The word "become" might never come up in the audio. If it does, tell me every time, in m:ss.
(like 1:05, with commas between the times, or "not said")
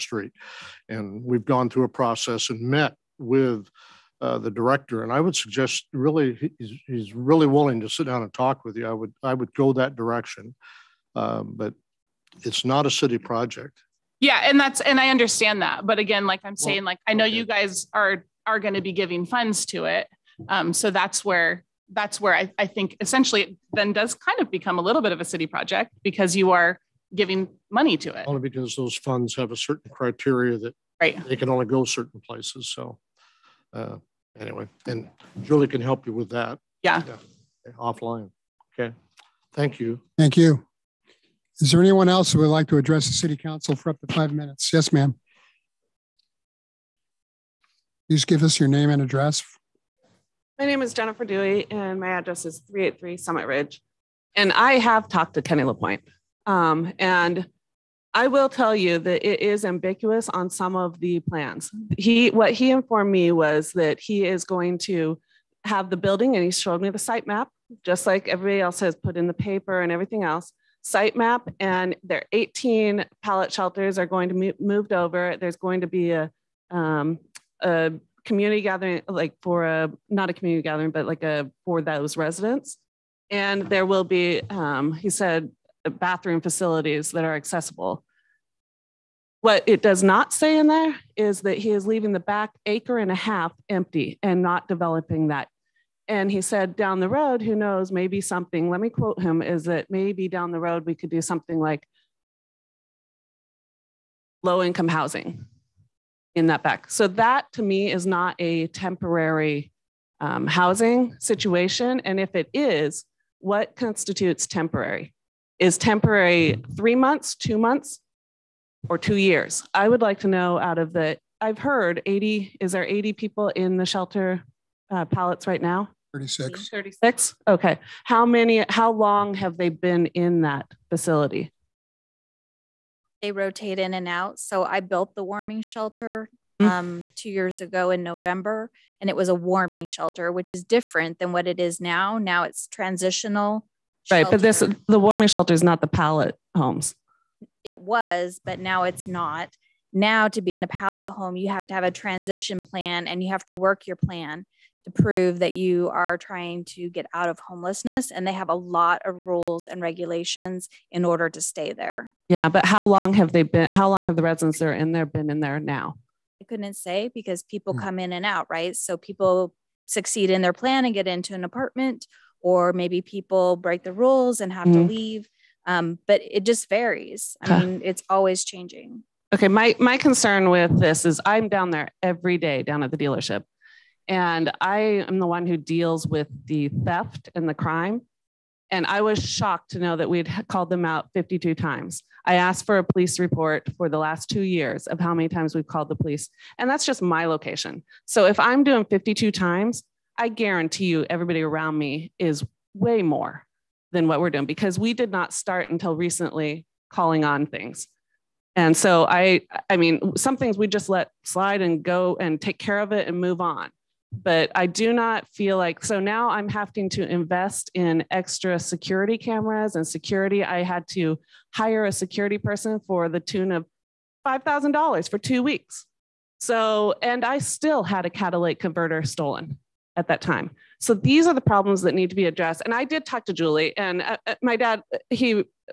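0:24.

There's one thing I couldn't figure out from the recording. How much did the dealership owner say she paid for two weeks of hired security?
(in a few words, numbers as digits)
$5,000.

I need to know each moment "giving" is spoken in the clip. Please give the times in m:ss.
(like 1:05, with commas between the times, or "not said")
0:18, 0:27.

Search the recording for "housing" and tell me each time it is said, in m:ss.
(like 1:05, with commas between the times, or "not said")
1:44, 1:50.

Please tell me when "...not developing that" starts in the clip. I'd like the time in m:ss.
1:34.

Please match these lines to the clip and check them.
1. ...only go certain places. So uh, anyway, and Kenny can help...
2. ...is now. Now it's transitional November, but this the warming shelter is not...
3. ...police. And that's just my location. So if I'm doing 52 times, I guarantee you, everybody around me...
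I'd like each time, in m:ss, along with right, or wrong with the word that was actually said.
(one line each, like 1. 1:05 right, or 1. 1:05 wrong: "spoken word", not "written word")
1. 0:31 wrong: "Julie", not "Kenny"
2. 2:21 wrong: "Right", not "November"
3. 3:15 right.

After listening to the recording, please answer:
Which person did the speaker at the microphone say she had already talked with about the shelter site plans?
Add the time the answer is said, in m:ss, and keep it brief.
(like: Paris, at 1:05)
Kenny LaPointe, at 0:55.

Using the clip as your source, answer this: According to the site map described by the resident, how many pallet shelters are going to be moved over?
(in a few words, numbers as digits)
18.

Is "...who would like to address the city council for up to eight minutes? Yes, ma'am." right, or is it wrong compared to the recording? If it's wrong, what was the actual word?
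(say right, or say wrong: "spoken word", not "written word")
wrong: "five", not "eight".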